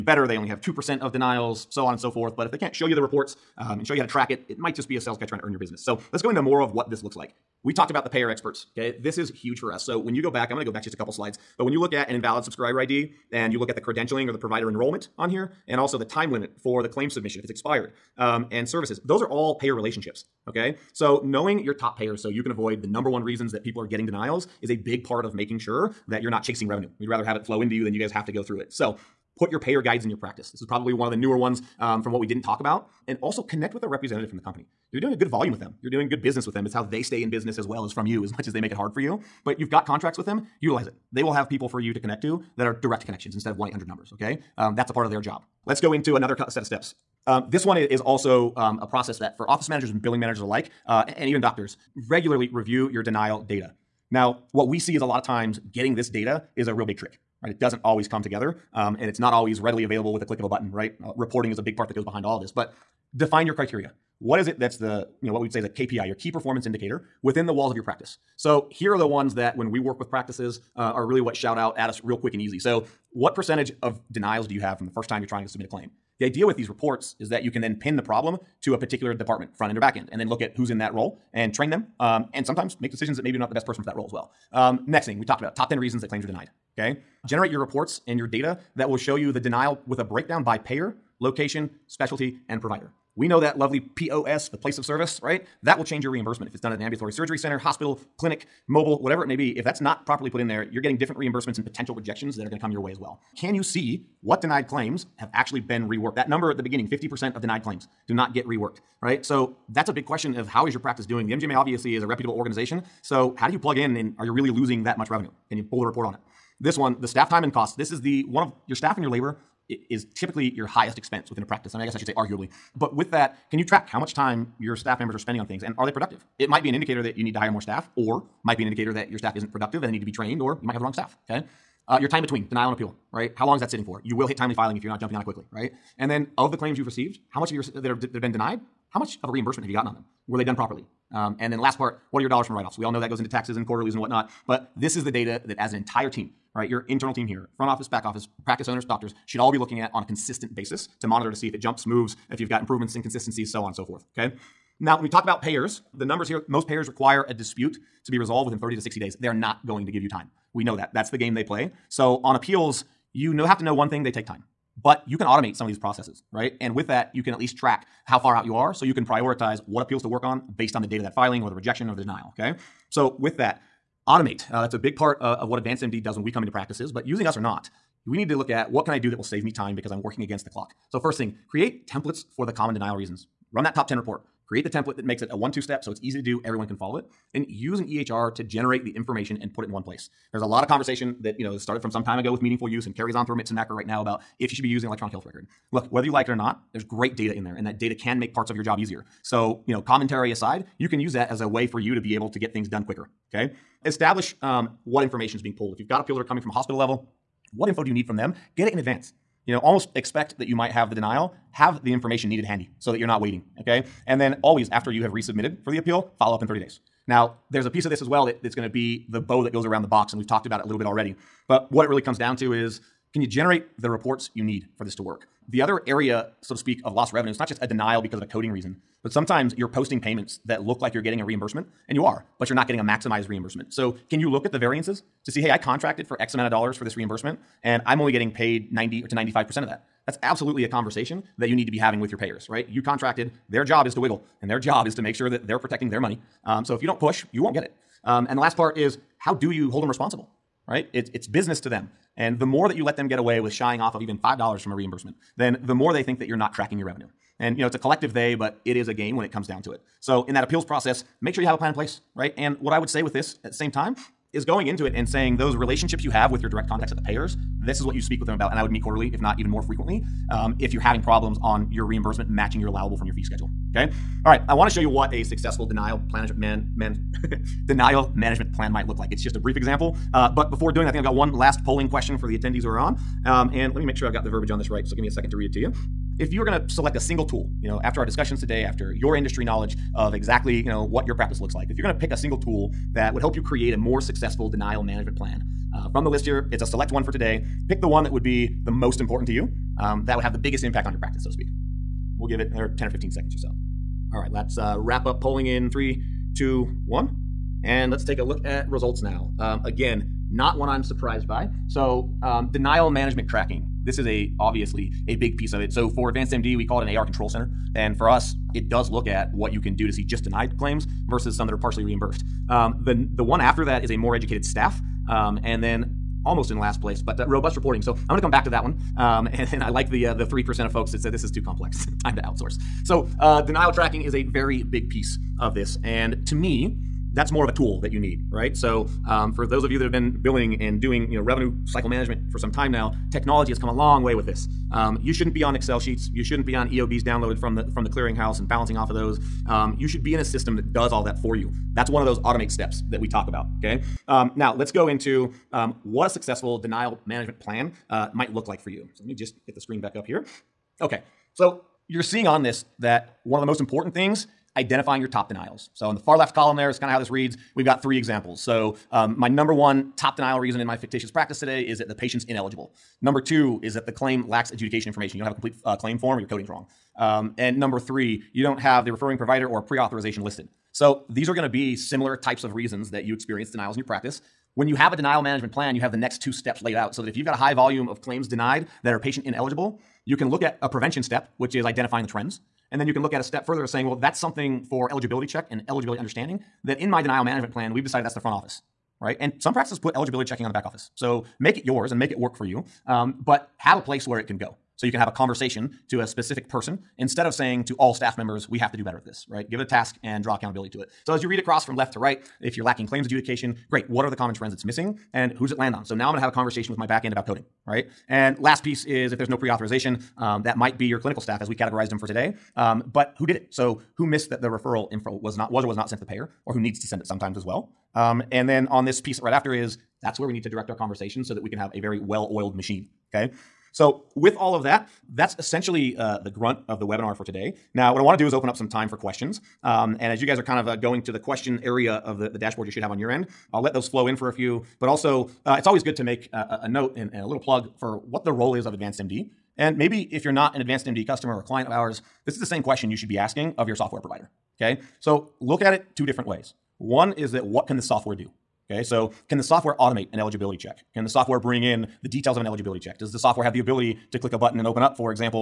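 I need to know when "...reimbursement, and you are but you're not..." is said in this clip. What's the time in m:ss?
3:51.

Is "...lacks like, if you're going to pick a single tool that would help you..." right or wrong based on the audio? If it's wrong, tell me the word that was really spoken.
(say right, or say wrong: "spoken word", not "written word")
wrong: "looks", not "lacks".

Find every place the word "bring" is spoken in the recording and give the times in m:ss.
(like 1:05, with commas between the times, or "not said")
7:41.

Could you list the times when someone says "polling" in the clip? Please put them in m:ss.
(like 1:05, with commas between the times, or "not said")
4:41, 5:05.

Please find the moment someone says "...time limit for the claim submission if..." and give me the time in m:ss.
0:16.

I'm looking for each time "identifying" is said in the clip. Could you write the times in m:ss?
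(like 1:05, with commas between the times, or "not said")
6:04, 6:31.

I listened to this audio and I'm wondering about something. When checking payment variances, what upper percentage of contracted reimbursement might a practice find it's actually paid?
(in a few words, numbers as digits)
95%.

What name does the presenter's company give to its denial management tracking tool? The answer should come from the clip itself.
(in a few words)
AR control center.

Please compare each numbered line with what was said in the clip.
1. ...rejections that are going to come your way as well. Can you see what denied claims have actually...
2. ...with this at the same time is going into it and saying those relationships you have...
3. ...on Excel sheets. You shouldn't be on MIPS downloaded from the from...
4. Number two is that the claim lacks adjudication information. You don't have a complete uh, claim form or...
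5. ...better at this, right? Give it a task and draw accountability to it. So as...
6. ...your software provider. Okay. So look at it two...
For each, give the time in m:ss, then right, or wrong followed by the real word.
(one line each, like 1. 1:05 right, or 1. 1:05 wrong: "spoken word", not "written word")
1. 1:41 right
2. 4:23 right
3. 5:45 wrong: "EOBs", not "MIPS"
4. 6:13 right
5. 6:48 right
6. 7:33 right.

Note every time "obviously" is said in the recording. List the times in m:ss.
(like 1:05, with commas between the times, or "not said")
1:51, 5:14.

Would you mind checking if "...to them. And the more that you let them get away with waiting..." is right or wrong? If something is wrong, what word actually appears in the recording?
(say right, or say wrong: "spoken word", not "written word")
wrong: "shying", not "waiting".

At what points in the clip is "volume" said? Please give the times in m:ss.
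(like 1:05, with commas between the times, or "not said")
0:35, 6:27.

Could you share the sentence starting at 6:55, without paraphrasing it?
So now I'm going to have a conversation with my back end about coding, right?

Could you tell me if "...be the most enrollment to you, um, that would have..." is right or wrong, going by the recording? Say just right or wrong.
wrong.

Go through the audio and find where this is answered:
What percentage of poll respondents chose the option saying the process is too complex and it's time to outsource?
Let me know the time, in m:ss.
5:30.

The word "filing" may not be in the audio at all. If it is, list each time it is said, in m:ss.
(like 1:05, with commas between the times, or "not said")
2:14, 2:51.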